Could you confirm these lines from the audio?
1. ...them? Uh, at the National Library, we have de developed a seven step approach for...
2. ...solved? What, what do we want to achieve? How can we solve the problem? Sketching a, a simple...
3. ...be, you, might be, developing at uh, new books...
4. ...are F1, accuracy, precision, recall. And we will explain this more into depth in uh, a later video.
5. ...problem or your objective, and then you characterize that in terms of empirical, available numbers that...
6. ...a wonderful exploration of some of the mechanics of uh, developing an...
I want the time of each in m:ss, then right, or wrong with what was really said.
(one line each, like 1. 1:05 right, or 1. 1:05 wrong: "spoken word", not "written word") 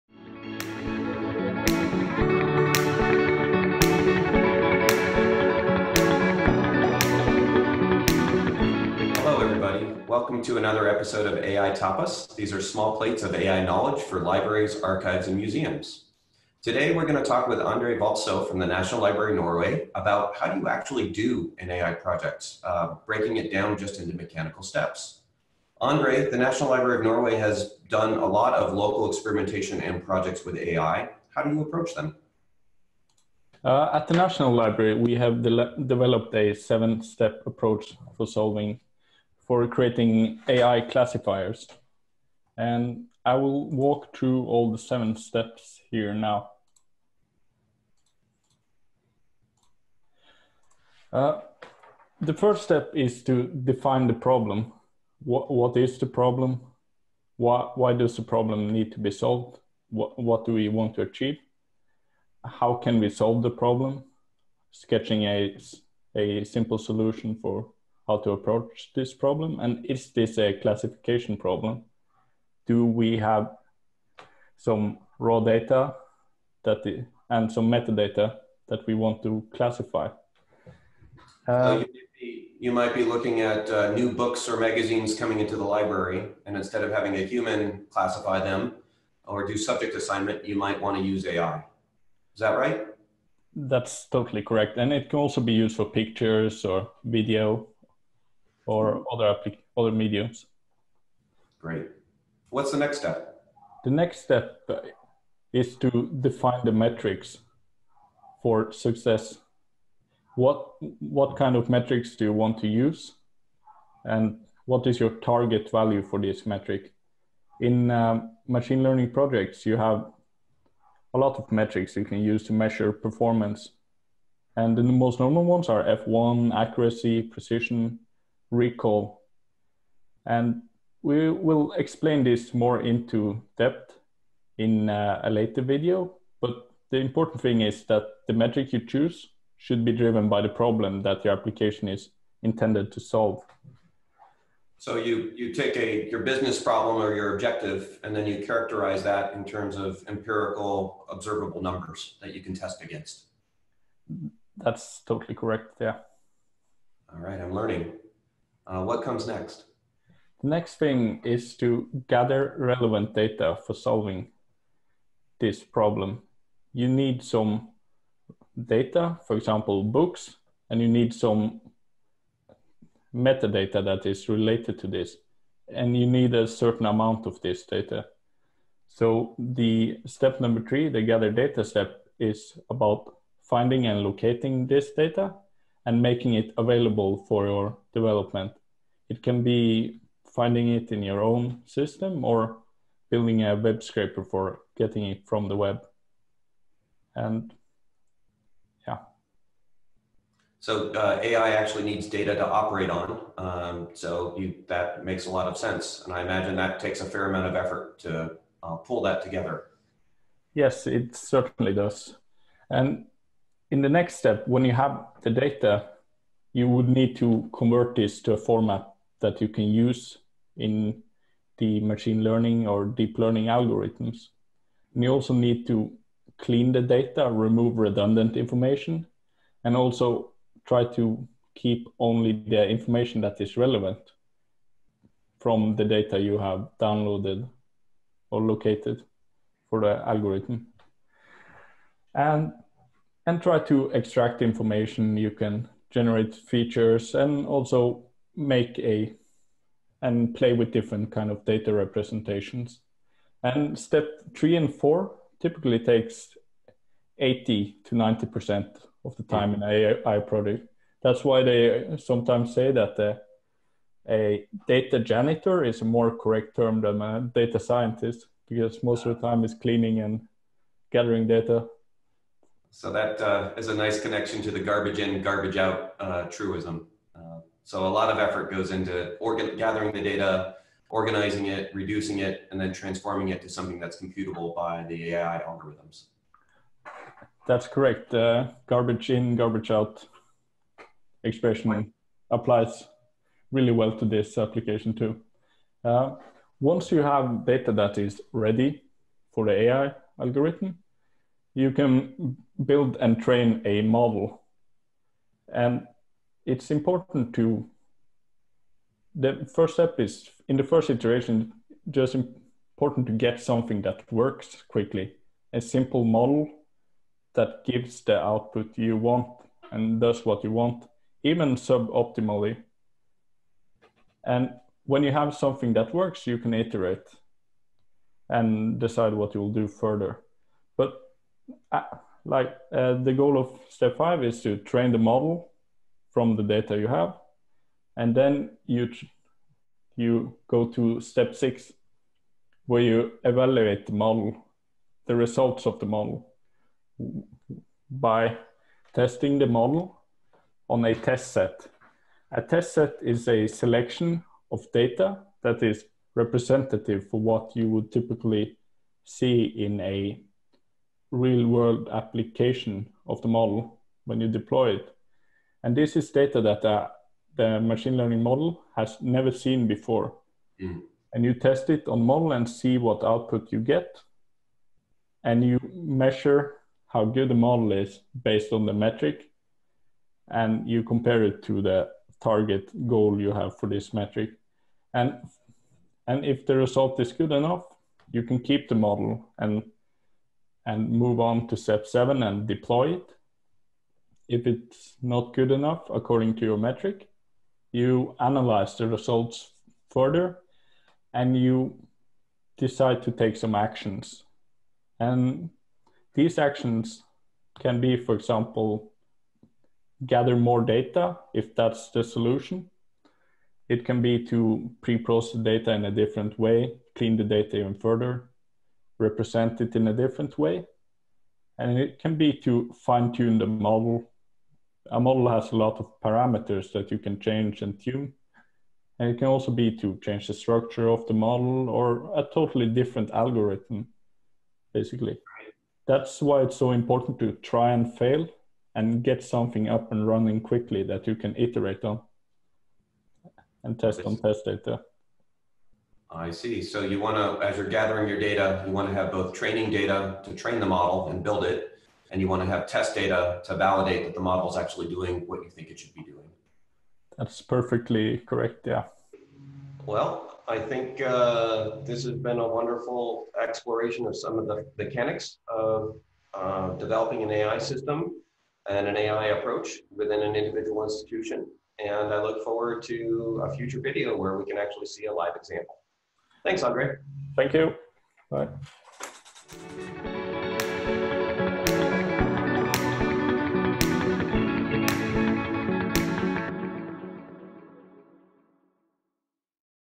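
1. 0:31 right
2. 0:59 right
3. 1:22 wrong: "looking", not "developing"
4. 2:05 right
5. 2:26 wrong: "observable", not "available"
6. 7:42 right.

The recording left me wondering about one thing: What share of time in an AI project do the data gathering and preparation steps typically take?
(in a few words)
80 to 90%.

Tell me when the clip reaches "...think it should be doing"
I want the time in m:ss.
7:35.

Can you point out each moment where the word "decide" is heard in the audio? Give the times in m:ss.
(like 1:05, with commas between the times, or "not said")
5:28, 6:42.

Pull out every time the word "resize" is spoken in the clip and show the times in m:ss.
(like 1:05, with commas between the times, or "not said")
not said.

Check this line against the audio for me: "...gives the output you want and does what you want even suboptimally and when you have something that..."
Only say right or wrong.
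right.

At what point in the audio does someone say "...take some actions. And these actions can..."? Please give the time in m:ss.
6:43.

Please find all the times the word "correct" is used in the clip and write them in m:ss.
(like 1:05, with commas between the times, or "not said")
1:34, 2:35, 4:26, 4:47, 7:38.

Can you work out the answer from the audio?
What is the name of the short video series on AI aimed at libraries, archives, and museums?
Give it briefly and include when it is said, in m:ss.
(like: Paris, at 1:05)
AI Tapas, at 0:11.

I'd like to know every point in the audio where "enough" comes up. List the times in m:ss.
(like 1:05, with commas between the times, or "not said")
6:27, 6:35.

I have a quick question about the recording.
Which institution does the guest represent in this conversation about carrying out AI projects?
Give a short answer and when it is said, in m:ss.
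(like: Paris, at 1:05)
National Library of Norway, at 0:18.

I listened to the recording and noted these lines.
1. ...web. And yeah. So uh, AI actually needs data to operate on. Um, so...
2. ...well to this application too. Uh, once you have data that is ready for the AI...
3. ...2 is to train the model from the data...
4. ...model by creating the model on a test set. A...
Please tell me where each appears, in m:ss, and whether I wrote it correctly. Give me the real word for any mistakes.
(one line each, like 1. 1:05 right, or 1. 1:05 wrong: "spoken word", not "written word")
1. 3:15 right
2. 4:53 right
3. 5:33 wrong: "5", not "2"
4. 5:45 wrong: "testing", not "creating".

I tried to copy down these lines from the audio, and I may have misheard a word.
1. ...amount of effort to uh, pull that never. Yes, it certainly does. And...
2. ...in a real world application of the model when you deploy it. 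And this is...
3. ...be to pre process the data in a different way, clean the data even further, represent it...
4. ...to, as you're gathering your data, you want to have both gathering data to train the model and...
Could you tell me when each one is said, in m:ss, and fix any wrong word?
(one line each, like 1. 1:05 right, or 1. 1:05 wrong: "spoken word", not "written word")
1. 3:27 wrong: "together", not "never"
2. 5:59 right
3. 6:54 right
4. 7:27 wrong: "training", not "gathering".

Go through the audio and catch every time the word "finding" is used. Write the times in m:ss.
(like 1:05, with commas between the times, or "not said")
3:03, 3:10.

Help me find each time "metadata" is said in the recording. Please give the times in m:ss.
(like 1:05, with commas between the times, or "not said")
1:17, 2:53.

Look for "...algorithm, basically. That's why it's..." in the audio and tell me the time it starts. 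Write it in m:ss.
7:13.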